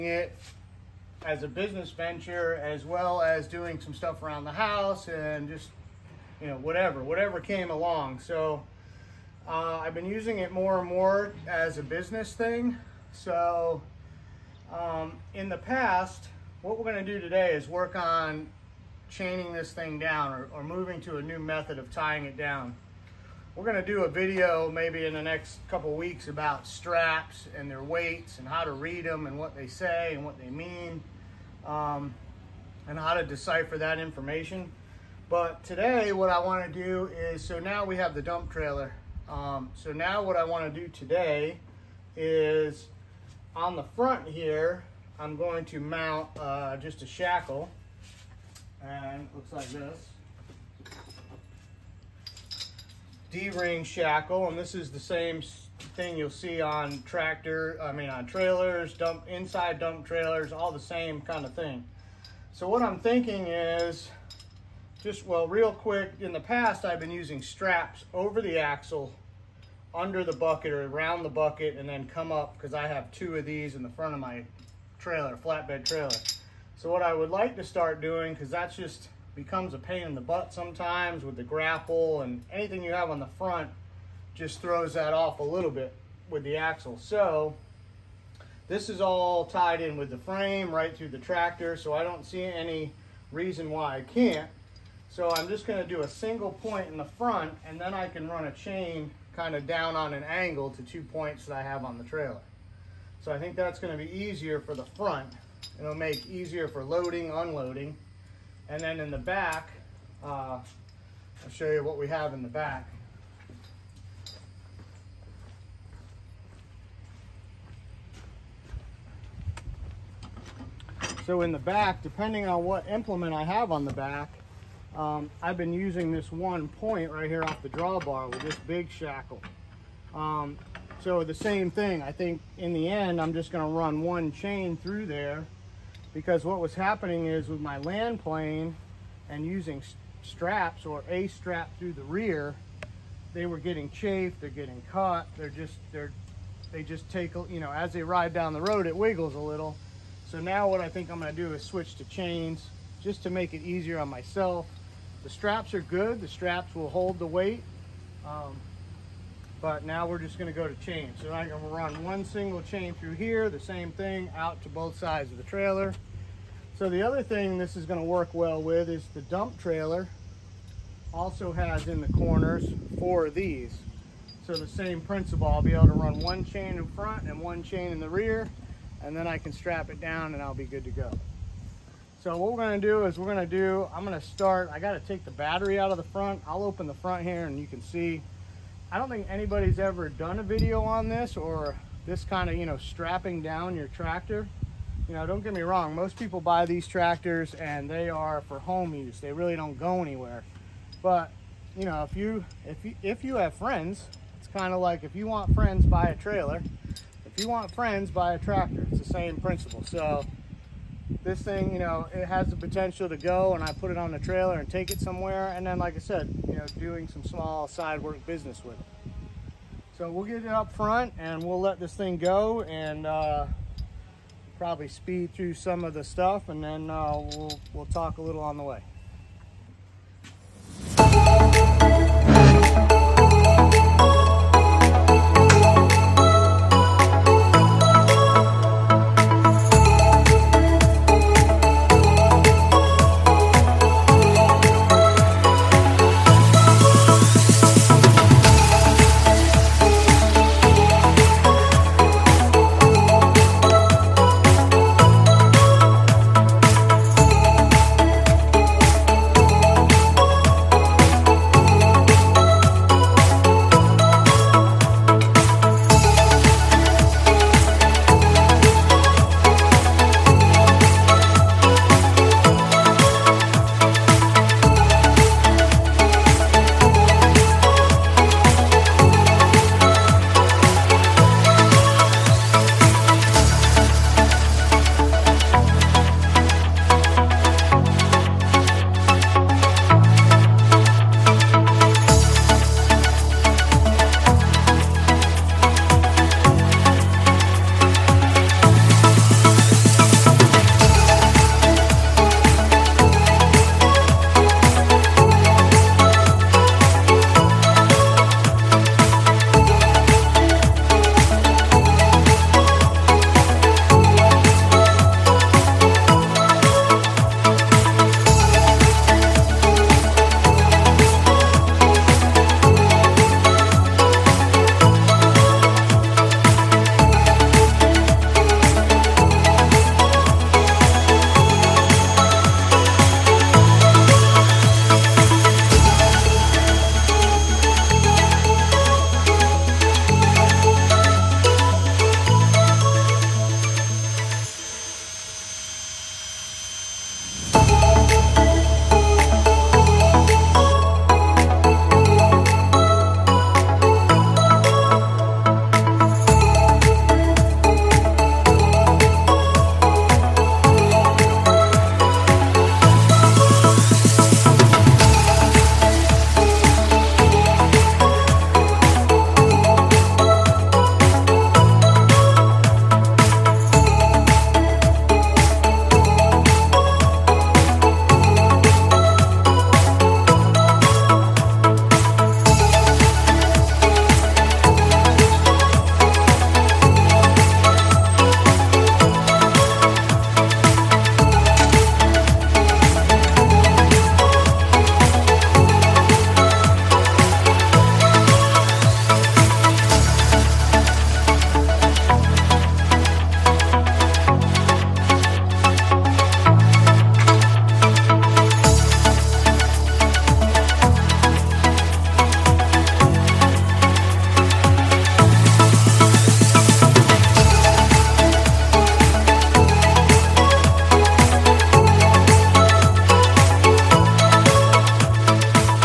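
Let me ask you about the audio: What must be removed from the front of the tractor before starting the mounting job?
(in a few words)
battery.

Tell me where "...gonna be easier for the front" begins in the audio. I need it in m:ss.
1:43.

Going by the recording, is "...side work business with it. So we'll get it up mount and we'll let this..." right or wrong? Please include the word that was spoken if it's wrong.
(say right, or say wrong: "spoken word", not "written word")
wrong: "front", not "mount".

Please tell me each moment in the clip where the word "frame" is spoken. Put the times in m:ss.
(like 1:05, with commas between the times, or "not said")
1:30.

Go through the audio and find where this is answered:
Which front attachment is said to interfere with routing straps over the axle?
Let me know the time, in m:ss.
1:21.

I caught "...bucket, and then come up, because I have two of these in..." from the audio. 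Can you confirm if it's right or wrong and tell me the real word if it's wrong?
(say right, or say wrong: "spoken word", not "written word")
right.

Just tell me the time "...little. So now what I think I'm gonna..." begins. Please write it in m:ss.
2:29.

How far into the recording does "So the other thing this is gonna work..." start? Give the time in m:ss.
2:46.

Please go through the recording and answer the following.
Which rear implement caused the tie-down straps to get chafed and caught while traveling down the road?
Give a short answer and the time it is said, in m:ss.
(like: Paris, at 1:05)
land plane, at 2:17.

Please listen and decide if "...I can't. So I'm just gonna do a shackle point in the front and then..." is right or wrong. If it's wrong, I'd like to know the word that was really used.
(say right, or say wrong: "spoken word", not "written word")
wrong: "single", not "shackle".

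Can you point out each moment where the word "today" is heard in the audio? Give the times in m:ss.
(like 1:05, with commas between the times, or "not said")
0:17, 0:35, 0:40.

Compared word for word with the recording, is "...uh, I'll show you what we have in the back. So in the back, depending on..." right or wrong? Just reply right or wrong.
right.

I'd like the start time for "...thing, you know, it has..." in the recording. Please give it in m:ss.
3:31.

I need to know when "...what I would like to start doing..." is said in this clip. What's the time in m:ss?
1:16.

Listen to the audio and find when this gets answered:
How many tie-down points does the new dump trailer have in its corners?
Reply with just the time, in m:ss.
2:52.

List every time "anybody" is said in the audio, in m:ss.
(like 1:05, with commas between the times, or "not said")
3:09.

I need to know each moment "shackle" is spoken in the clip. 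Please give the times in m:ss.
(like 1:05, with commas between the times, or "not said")
0:47, 0:53, 2:08.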